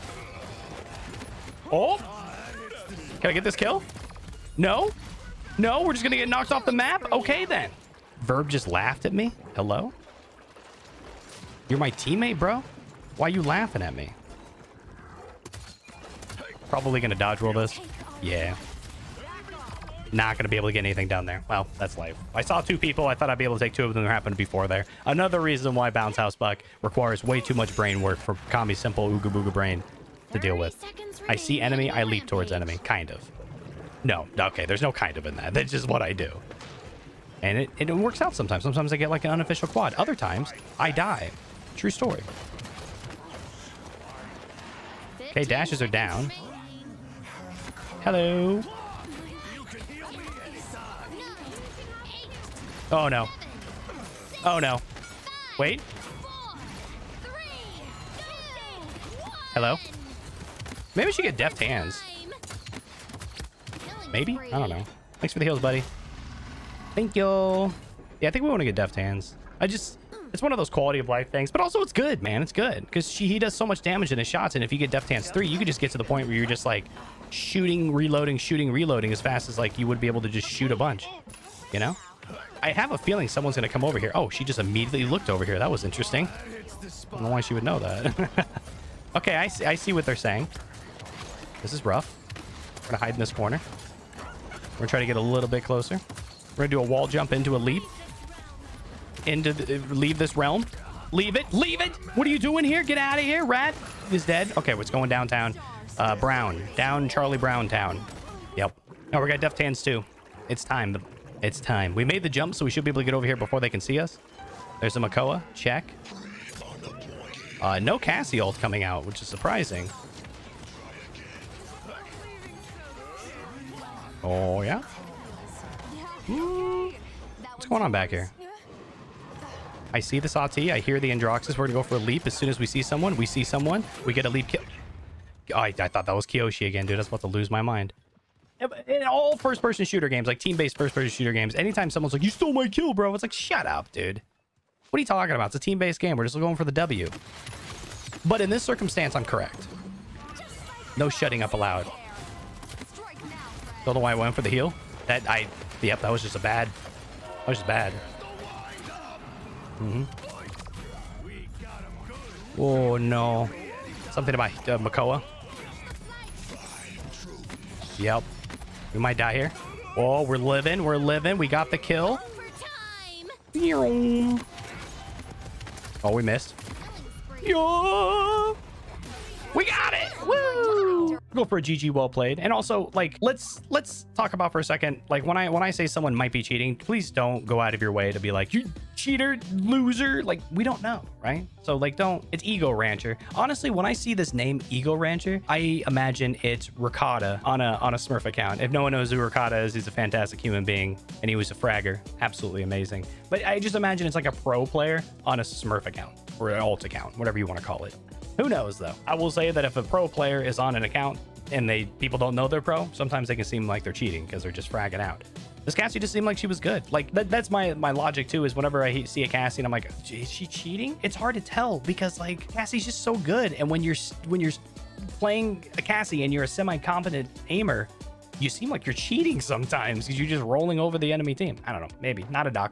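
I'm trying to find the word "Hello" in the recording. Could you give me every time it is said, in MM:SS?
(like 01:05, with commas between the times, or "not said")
00:09, 00:48, 00:59.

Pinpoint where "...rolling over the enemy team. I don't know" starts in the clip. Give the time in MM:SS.
03:50.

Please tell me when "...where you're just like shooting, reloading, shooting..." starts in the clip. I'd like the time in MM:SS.
01:16.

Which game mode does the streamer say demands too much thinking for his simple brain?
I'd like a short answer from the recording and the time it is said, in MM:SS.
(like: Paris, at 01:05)
Bounce House Buck, at 00:25.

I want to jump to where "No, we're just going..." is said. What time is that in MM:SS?
00:05.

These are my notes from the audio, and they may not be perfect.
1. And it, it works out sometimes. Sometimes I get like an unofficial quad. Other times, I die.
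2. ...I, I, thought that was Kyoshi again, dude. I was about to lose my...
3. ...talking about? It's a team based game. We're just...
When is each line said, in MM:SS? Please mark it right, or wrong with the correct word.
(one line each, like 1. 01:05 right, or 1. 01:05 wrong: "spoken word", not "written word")
1. 00:37 right
2. 02:15 right
3. 02:25 right.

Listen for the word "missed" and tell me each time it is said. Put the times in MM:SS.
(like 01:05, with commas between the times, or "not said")
02:56.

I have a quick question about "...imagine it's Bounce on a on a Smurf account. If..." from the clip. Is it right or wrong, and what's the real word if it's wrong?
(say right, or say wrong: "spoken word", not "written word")
wrong: "Ricotta", not "Bounce".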